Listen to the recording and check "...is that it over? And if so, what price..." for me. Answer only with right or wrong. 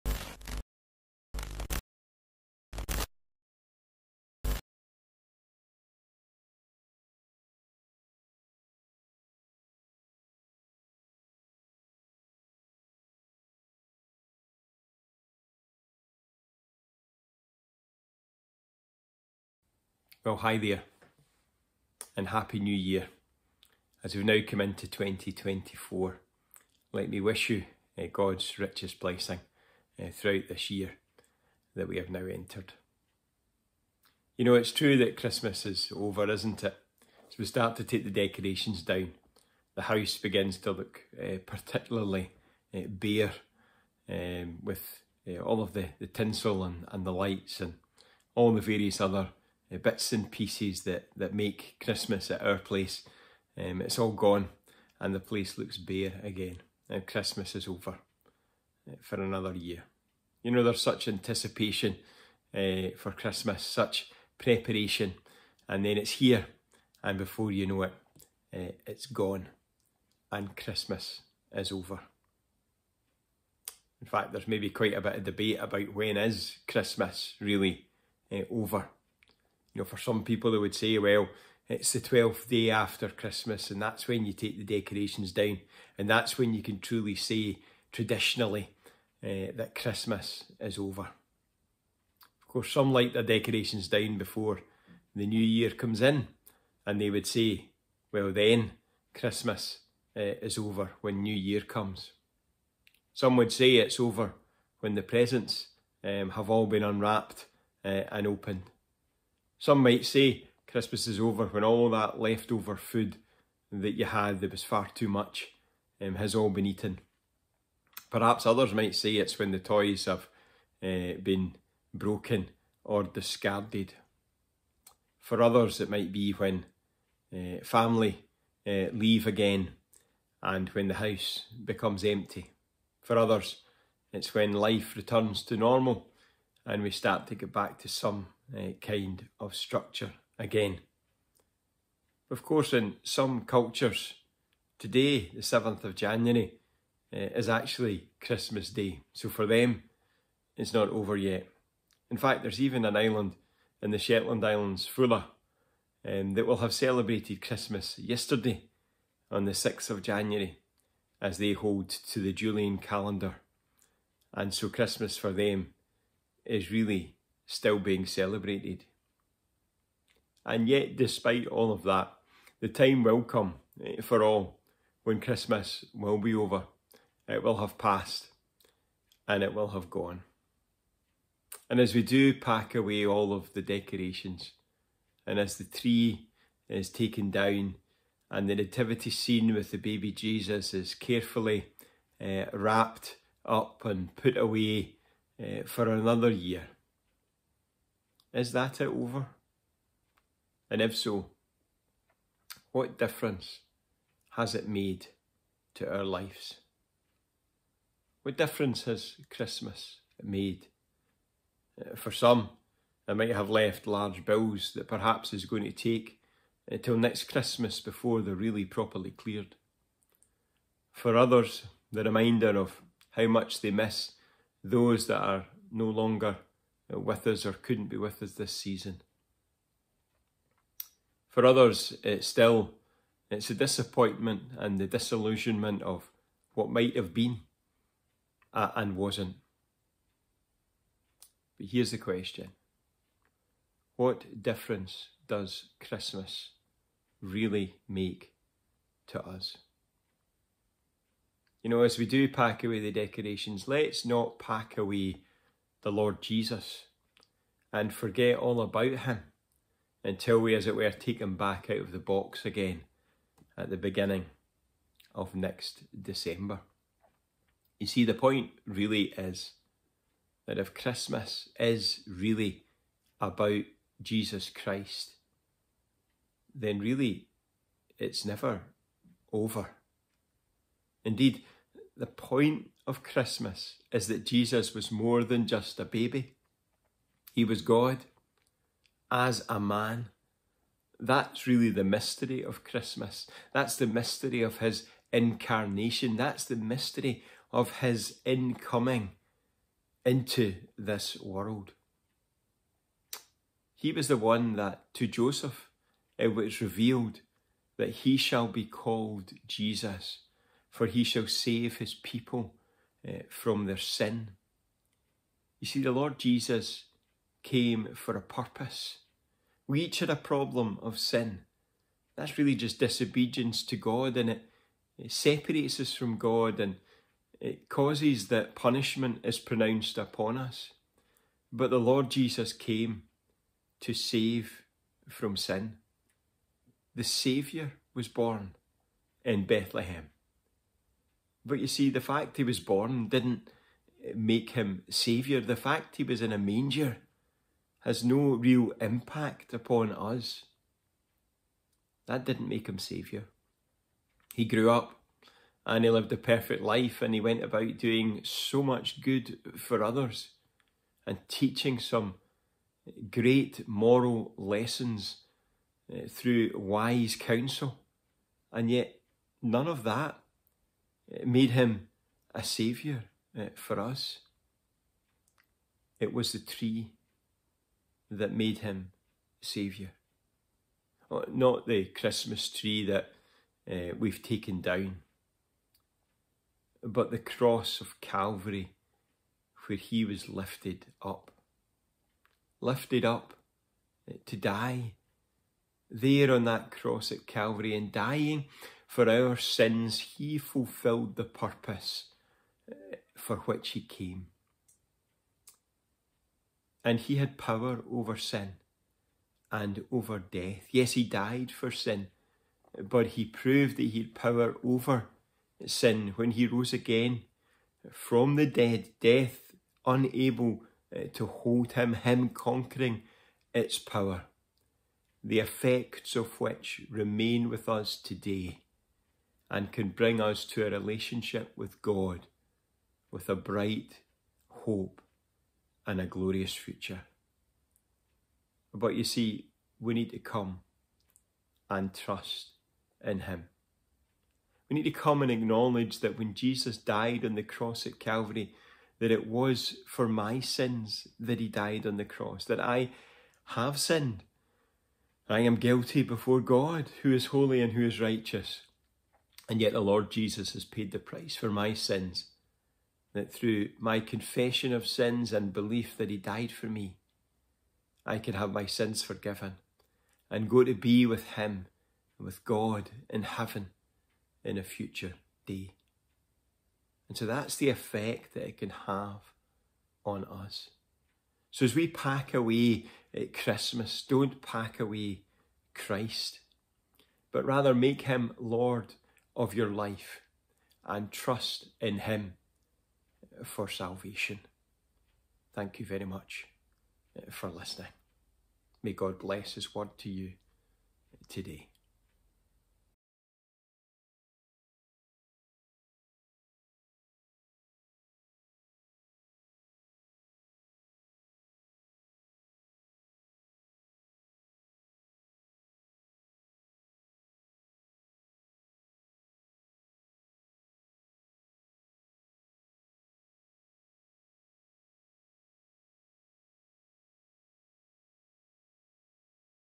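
wrong.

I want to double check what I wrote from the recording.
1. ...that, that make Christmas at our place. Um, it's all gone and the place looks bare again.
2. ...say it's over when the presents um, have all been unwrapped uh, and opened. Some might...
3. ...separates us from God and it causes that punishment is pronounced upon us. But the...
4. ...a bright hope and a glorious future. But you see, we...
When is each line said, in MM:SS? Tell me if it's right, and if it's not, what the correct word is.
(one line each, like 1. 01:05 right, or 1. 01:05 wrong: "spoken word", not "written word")
1. 00:50 right
2. 01:43 right
3. 05:25 right
4. 07:13 right.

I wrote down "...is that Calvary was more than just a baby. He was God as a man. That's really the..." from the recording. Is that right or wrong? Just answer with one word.
wrong.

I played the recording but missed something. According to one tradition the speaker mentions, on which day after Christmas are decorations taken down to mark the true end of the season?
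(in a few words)
12th day.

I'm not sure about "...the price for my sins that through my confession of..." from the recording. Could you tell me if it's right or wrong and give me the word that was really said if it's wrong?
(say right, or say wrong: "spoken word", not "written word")
right.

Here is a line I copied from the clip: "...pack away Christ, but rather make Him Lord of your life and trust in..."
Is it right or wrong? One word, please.
right.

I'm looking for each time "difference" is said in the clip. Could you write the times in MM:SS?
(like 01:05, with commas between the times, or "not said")
03:22, 03:28, 04:04.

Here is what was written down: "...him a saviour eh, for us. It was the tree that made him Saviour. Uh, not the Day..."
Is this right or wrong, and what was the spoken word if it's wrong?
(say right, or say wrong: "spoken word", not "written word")
wrong: "Christmas", not "Day".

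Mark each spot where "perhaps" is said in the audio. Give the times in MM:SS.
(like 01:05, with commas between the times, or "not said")
01:58, 03:34.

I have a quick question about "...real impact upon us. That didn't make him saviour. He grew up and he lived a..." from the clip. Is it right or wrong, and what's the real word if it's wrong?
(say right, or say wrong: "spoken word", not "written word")
right.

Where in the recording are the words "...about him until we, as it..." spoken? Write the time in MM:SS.
04:18.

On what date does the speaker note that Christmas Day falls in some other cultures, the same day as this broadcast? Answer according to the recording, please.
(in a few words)
7th of January.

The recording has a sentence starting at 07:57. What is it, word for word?
And so that's the effect that it can have on us.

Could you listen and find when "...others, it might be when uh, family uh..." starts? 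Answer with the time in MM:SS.
02:05.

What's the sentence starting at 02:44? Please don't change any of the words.
And so Christmas for them is really still being celebrated.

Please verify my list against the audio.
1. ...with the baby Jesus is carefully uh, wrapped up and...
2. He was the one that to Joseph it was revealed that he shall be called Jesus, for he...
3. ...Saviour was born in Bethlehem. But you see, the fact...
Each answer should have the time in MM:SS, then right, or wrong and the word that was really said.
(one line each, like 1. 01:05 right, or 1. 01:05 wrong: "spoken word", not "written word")
1. 03:09 right
2. 05:03 right
3. 05:37 right.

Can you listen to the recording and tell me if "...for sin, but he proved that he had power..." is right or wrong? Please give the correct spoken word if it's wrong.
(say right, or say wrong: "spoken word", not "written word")
right.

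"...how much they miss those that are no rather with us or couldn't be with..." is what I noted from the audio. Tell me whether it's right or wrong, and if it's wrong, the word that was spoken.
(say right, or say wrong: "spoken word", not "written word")
wrong: "longer", not "rather".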